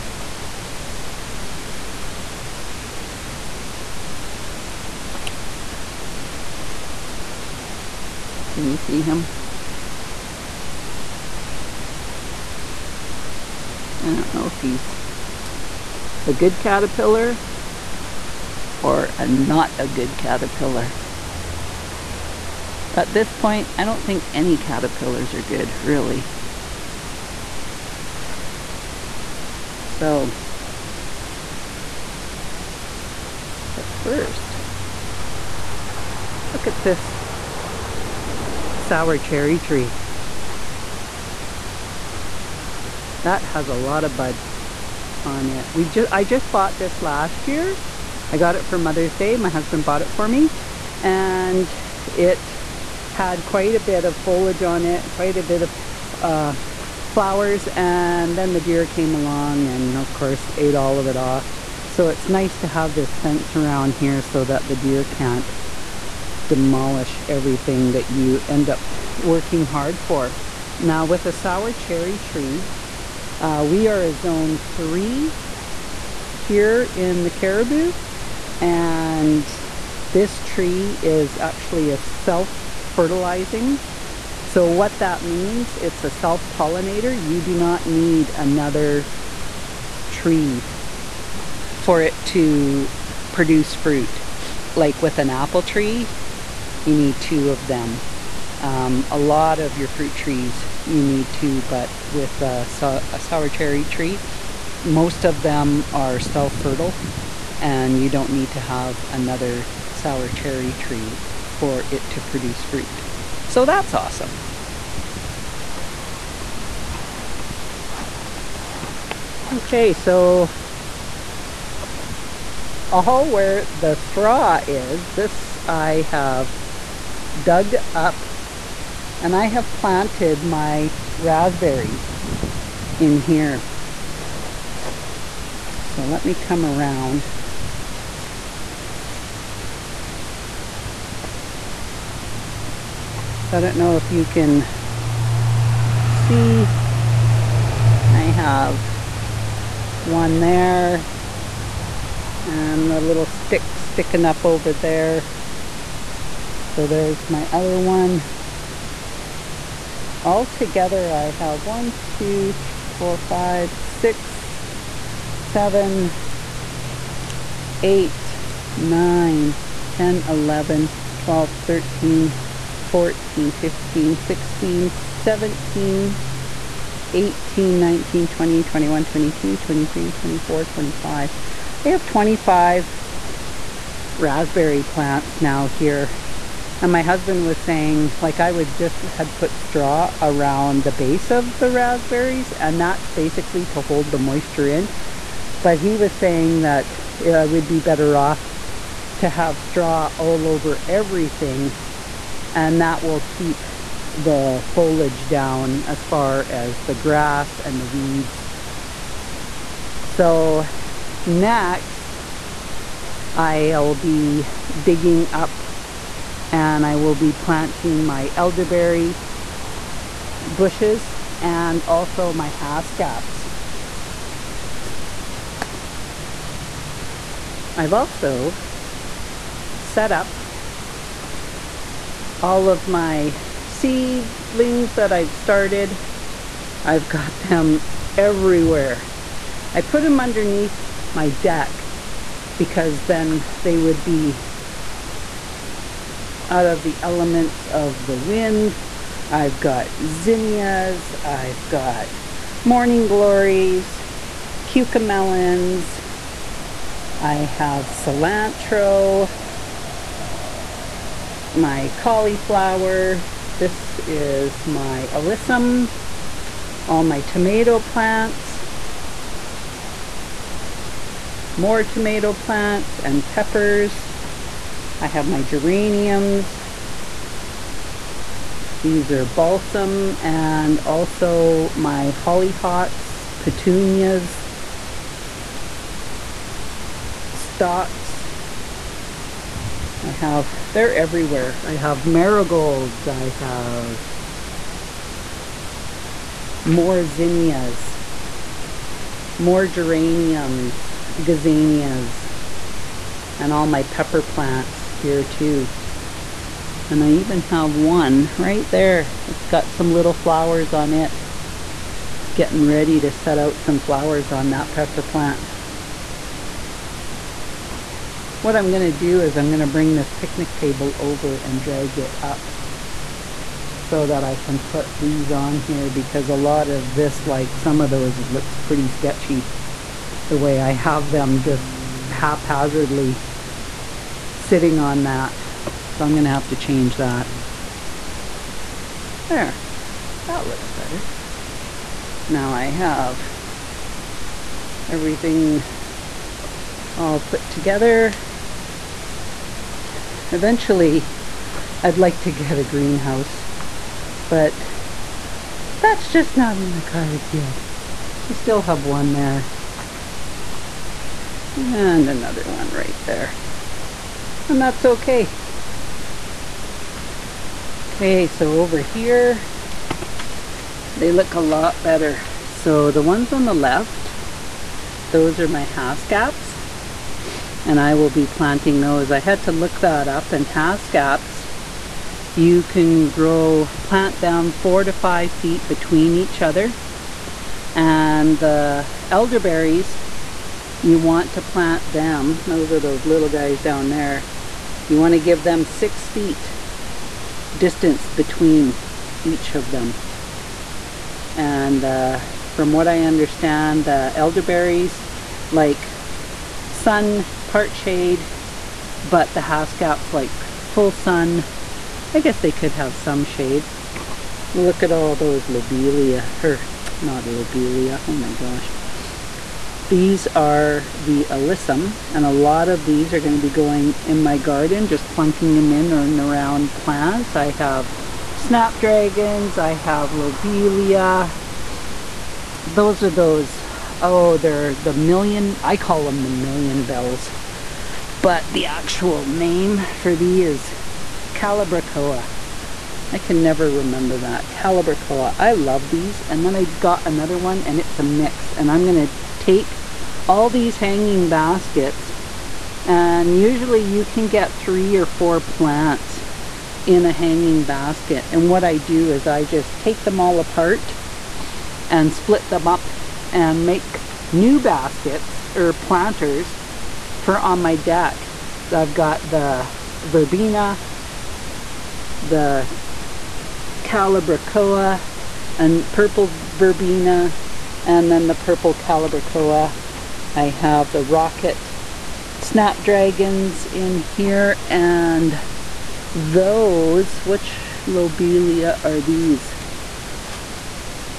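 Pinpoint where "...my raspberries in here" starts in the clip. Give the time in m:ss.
2:10.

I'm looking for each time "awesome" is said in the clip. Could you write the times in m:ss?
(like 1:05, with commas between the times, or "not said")
1:53.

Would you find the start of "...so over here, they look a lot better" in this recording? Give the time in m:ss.
6:08.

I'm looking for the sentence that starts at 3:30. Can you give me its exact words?
So next I'll be digging up and I will be planting my elderberry bushes and also my caps.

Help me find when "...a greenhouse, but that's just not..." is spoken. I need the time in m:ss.
5:52.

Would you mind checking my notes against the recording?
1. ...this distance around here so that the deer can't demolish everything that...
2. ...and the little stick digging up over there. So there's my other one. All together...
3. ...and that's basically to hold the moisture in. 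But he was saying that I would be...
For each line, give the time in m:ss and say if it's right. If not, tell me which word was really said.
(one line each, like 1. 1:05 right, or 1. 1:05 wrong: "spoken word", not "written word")
1. 1:02 wrong: "fence", not "distance"
2. 2:32 wrong: "sticking", not "digging"
3. 3:12 right.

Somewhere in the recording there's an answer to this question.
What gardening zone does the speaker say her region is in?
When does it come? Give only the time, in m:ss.
1:14.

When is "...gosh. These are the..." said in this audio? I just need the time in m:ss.
6:58.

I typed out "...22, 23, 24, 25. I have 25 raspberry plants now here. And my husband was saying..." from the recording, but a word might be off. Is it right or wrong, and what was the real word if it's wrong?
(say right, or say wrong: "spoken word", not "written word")
right.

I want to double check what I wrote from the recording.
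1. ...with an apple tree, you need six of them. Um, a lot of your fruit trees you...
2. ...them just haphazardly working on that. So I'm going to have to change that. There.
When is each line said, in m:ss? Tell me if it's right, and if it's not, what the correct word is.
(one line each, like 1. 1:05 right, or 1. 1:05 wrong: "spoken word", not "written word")
1. 1:35 wrong: "two", not "six"
2. 5:31 wrong: "sitting", not "working".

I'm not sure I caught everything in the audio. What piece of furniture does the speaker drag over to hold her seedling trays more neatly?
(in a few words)
picnic table.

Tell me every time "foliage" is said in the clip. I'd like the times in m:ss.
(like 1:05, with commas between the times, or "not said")
0:54, 3:24.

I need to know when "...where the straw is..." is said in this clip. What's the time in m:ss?
2:03.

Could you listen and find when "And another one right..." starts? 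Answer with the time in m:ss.
6:01.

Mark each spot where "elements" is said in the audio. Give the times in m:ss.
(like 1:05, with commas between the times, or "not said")
4:07.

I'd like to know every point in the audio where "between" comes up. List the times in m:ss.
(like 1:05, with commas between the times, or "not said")
6:25, 6:38.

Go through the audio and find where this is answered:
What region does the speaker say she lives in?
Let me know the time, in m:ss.
1:17.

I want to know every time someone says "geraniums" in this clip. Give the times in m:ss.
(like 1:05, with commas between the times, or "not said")
4:35, 4:59.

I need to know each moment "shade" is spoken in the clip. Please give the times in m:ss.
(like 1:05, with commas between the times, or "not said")
6:47, 6:53.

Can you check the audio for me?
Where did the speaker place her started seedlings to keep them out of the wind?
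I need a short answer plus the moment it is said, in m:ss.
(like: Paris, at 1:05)
underneath my deck, at 4:00.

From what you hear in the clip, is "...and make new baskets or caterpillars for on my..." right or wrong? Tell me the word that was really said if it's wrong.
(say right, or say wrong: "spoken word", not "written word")
wrong: "planters", not "caterpillars".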